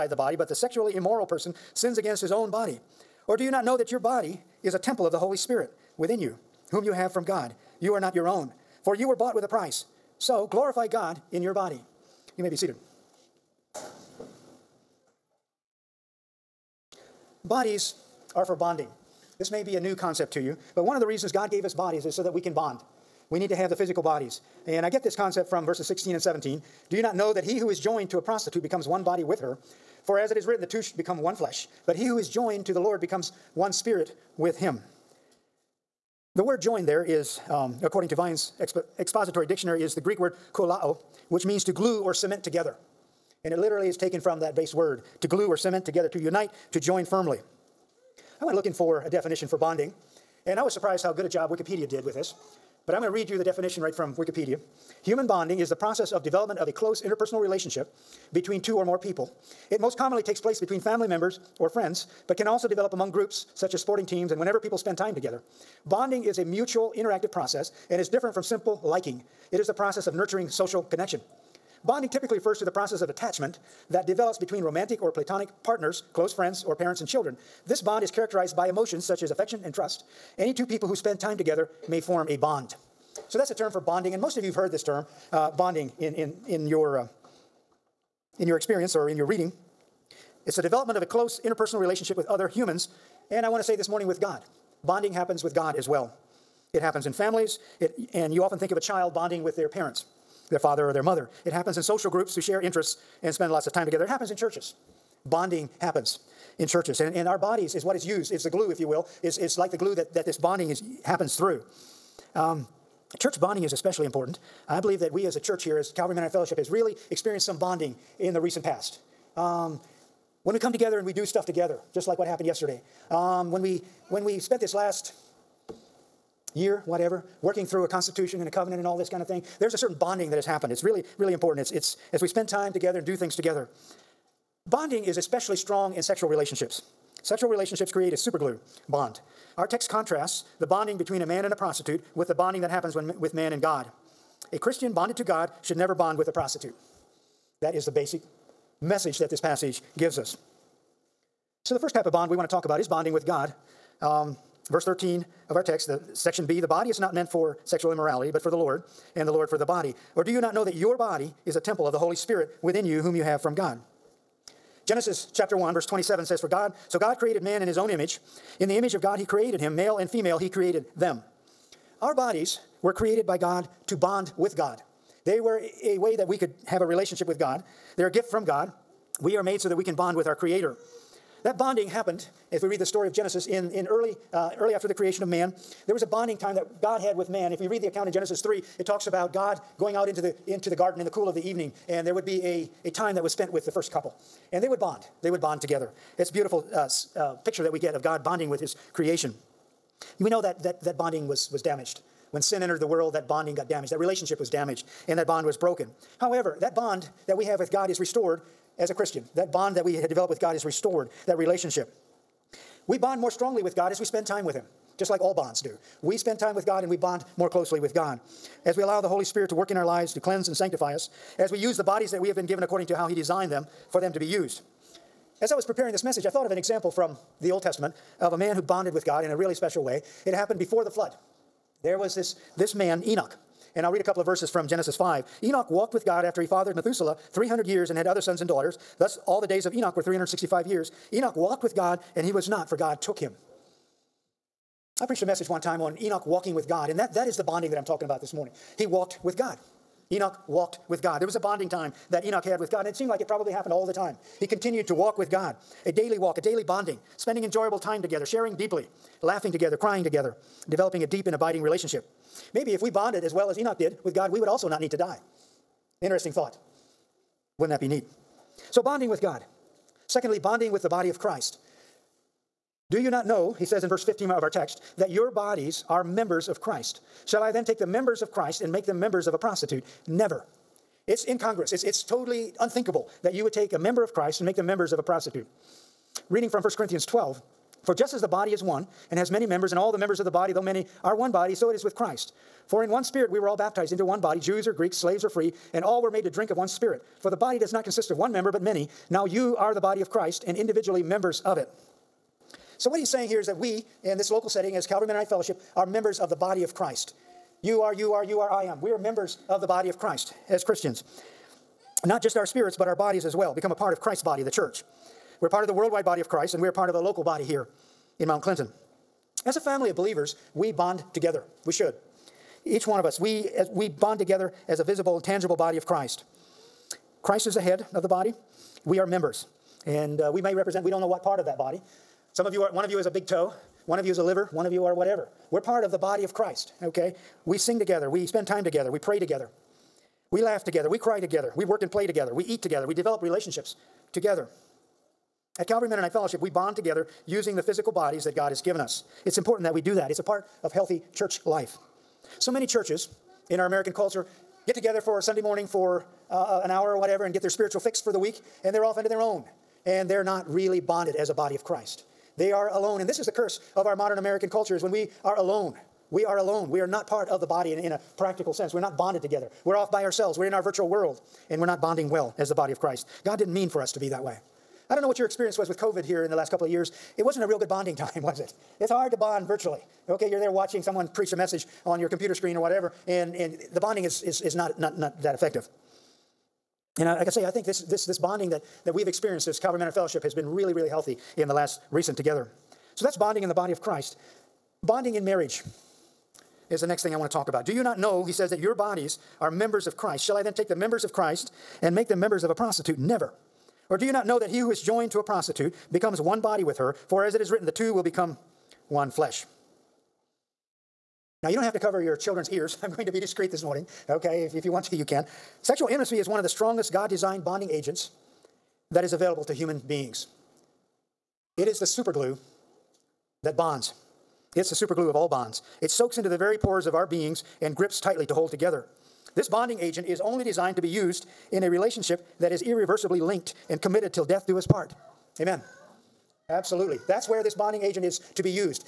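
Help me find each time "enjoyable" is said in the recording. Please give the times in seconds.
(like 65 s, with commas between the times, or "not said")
257 s.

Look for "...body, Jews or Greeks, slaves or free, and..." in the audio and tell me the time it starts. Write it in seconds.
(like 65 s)
294 s.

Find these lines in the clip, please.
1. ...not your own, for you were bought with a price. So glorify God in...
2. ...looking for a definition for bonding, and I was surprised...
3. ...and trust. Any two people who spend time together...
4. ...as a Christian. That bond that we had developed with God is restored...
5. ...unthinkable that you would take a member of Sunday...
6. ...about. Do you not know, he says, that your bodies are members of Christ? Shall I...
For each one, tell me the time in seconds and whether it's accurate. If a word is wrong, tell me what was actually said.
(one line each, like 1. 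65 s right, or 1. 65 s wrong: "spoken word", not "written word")
1. 7 s right
2. 48 s right
3. 79 s right
4. 208 s right
5. 282 s wrong: "Christ", not "Sunday"
6. 397 s right.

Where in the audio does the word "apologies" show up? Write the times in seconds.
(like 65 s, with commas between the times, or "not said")
not said.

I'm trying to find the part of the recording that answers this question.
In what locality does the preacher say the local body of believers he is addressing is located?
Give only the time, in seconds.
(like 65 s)
318 s.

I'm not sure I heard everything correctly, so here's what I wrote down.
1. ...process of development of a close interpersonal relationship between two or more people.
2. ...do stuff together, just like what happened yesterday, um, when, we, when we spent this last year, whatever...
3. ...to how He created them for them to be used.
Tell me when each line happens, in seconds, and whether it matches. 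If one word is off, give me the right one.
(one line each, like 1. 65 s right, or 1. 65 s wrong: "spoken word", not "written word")
1. 55 s right
2. 121 s right
3. 222 s wrong: "designed", not "created".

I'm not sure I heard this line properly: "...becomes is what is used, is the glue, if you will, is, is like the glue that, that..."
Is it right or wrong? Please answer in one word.
wrong.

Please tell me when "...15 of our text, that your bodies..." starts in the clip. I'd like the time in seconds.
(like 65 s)
274 s.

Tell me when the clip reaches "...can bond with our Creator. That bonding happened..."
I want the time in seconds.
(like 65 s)
179 s.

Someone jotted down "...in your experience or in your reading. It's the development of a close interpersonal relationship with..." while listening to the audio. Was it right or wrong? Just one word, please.
right.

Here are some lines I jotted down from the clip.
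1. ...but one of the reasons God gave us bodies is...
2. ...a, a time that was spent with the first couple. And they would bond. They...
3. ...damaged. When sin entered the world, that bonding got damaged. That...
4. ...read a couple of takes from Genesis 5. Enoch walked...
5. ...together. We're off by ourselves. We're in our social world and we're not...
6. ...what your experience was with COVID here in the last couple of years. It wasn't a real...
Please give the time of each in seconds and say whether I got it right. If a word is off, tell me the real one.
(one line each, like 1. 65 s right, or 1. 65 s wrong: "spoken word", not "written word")
1. 20 s right
2. 192 s right
3. 201 s right
4. 233 s wrong: "verses", not "takes"
5. 369 s wrong: "virtual", not "social"
6. 375 s right.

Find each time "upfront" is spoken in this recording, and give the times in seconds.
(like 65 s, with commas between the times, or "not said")
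not said.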